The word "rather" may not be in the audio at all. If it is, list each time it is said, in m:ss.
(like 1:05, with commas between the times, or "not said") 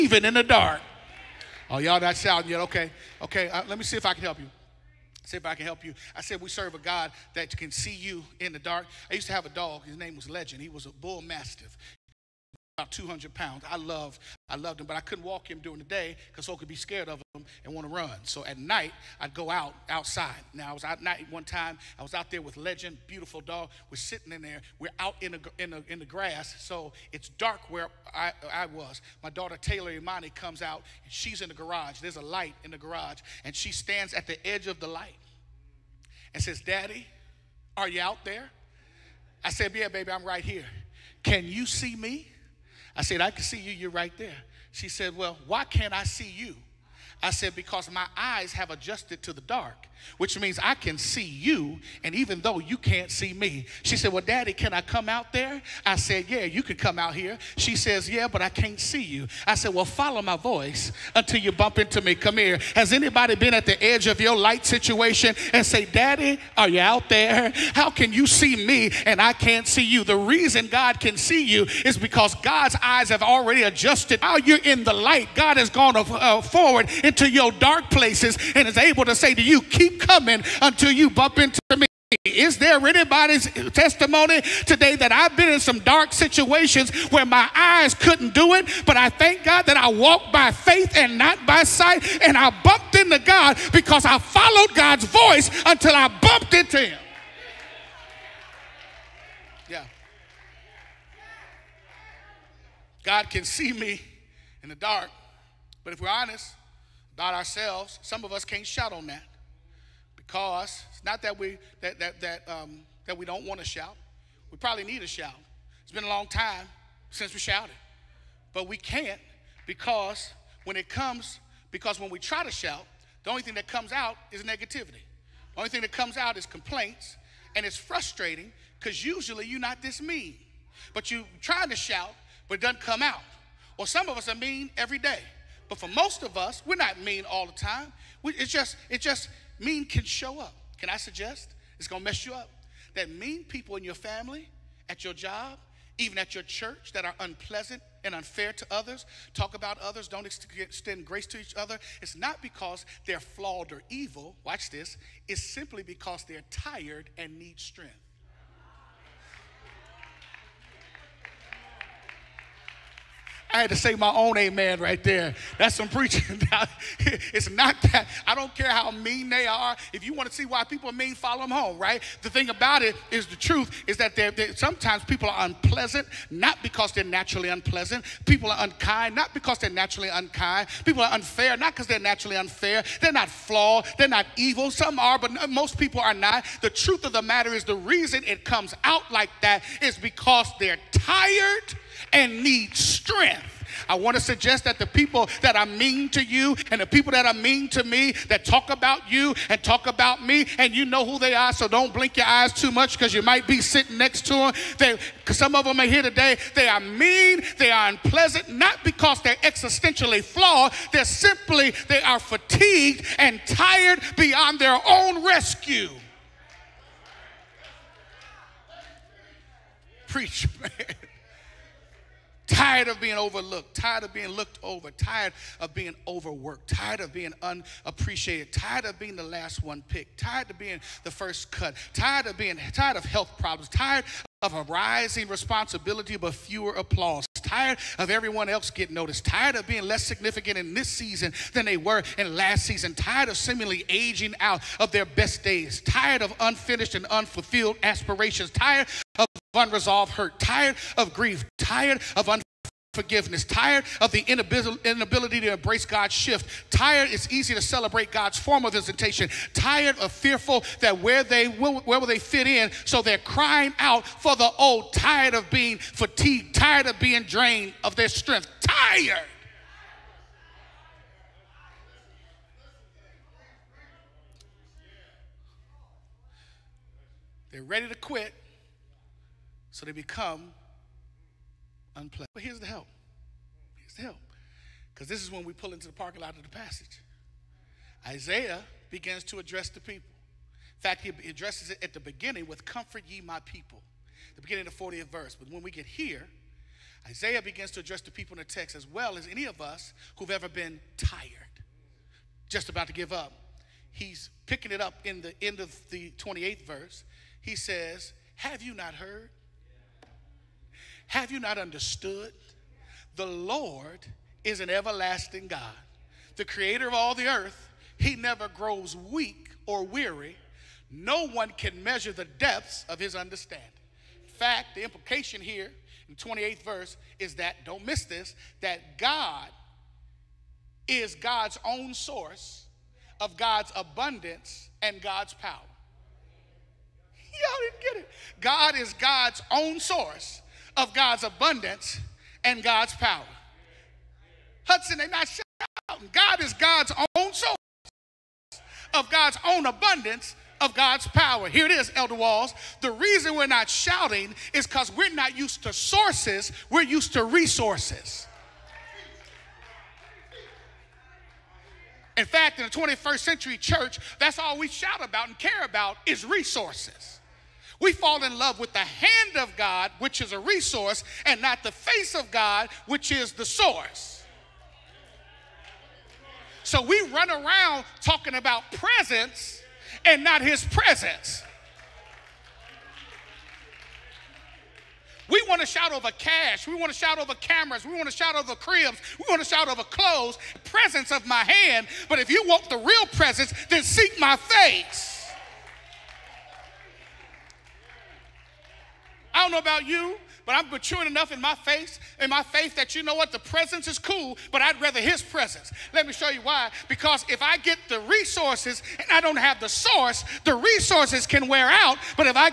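6:44.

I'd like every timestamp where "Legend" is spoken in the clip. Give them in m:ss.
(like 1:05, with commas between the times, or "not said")
0:10, 0:22.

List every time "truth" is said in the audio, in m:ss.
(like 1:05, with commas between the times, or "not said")
2:53, 3:06.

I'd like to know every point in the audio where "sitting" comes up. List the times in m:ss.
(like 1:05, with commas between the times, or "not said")
0:23, 3:23.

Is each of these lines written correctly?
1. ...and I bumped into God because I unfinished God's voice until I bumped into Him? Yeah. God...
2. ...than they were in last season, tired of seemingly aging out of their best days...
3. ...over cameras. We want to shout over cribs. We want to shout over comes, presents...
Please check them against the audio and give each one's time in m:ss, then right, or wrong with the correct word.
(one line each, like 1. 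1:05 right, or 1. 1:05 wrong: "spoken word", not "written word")
1. 1:32 wrong: "followed", not "unfinished"
2. 4:01 right
3. 6:27 wrong: "clothes", not "comes".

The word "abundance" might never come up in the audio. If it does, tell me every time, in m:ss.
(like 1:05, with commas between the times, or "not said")
5:33, 5:41, 5:49.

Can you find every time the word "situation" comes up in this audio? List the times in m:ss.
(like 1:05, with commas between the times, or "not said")
1:04, 1:26.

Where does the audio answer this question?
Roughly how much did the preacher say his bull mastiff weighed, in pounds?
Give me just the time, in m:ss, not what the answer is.
0:12.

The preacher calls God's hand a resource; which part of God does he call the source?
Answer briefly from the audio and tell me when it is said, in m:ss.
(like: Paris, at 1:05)
The face of God, at 6:11.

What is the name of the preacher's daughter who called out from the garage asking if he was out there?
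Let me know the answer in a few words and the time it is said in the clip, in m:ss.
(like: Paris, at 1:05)
Taylor Imani, at 0:29.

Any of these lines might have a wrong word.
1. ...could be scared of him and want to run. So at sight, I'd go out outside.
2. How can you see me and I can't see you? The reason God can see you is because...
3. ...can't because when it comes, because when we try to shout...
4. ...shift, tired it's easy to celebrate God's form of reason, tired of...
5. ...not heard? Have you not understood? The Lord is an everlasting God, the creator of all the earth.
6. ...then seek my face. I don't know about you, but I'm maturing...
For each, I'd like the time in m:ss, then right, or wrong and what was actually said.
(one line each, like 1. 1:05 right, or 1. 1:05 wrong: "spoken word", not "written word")
1. 0:16 wrong: "night", not "sight"
2. 1:07 right
3. 1:58 right
4. 4:16 wrong: "visitation", not "reason"
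5. 5:08 right
6. 6:33 right.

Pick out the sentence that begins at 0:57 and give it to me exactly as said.
She says, Yeah, but I can't see you.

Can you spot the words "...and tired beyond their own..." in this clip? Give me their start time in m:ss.
3:33.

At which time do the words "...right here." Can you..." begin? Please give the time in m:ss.
0:40.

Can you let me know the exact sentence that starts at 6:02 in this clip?
In fact, in the 21st century church, that's all we shout about and care about is resources.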